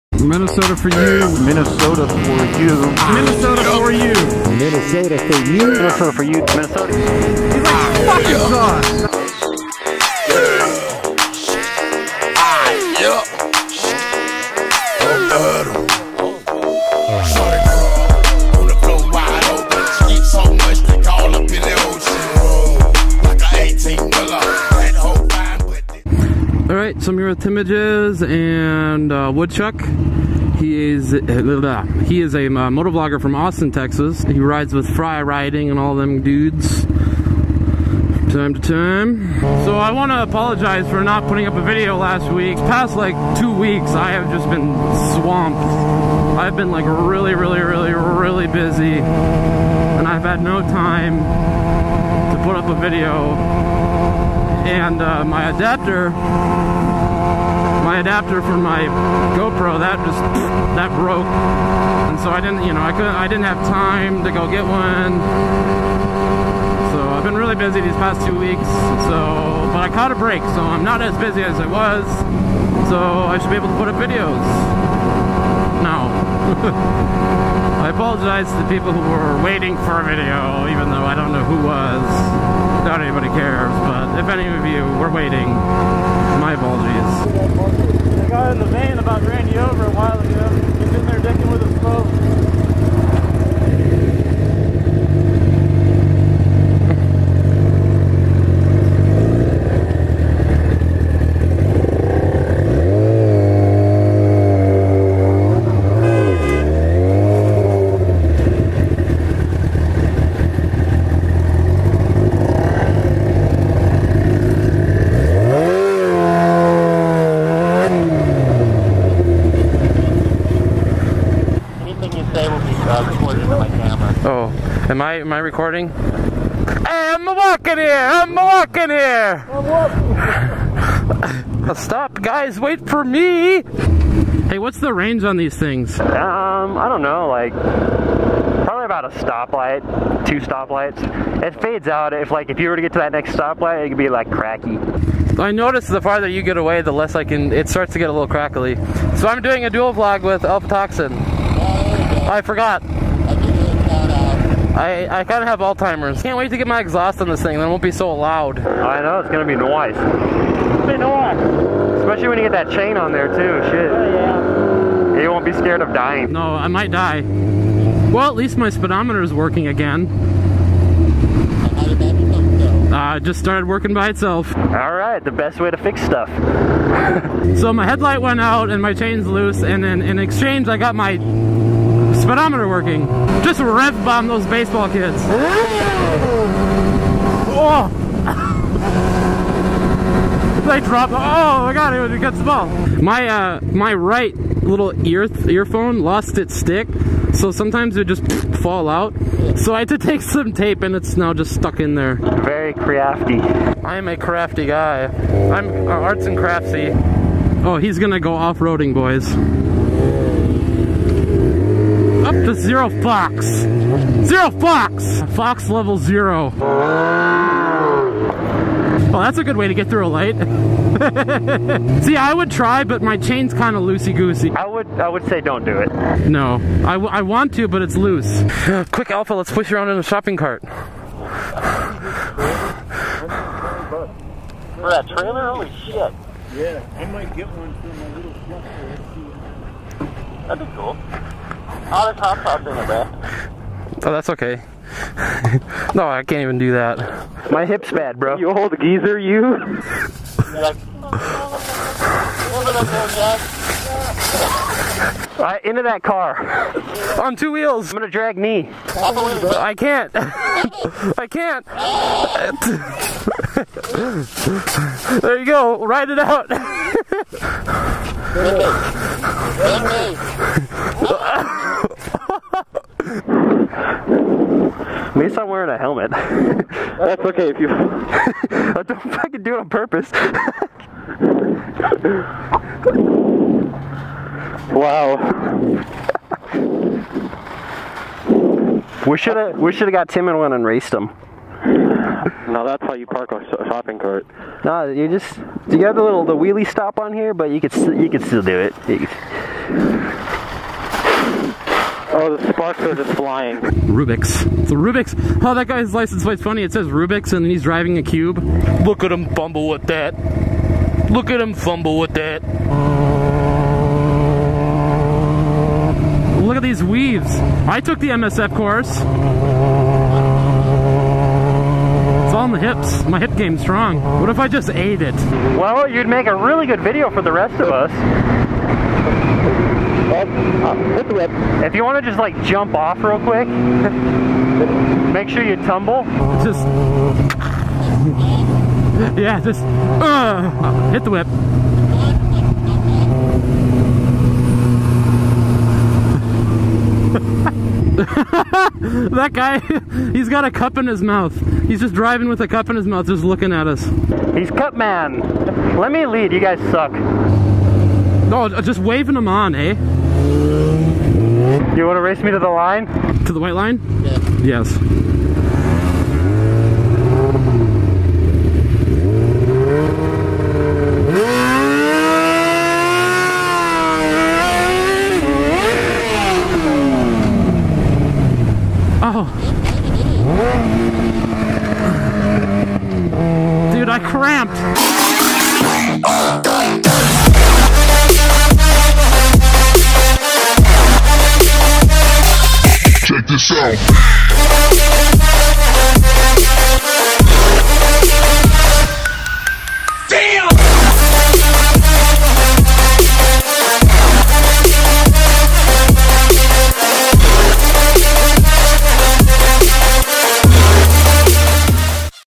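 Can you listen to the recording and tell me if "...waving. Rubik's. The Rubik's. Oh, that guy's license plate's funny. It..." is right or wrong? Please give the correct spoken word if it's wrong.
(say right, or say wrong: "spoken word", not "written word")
wrong: "flying", not "waving".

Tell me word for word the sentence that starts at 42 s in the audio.
Past like two weeks, I have just been swamped.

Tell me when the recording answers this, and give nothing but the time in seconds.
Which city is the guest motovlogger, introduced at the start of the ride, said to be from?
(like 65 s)
33 s.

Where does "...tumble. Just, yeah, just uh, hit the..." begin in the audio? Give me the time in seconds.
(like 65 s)
335 s.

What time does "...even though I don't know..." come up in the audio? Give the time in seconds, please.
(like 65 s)
80 s.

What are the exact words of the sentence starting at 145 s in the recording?
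I notice the farther you get away, the less I can.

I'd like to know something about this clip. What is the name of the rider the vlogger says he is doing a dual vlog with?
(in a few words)
Alpha Toxin.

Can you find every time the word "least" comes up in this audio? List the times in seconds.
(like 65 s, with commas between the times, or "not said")
168 s, 275 s.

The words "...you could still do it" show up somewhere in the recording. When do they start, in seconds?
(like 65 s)
297 s.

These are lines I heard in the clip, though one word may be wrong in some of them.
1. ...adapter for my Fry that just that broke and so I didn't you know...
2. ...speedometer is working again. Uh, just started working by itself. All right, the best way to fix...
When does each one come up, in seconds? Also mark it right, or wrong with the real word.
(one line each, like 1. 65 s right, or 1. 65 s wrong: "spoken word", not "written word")
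1. 57 s wrong: "GoPro", not "Fry"
2. 168 s right.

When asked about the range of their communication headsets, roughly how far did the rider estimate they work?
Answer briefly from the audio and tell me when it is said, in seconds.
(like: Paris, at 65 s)
two stoplights, at 140 s.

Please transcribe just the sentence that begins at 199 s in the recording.
So I had to take some tape, and it's now just stuck in there.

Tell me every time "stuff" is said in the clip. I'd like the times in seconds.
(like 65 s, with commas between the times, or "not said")
176 s.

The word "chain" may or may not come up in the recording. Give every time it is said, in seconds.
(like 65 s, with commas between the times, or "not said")
162 s, 178 s, 223 s.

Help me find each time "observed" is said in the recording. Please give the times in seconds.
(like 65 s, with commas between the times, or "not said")
not said.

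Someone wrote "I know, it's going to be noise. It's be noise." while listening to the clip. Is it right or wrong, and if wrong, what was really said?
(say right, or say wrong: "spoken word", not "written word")
right.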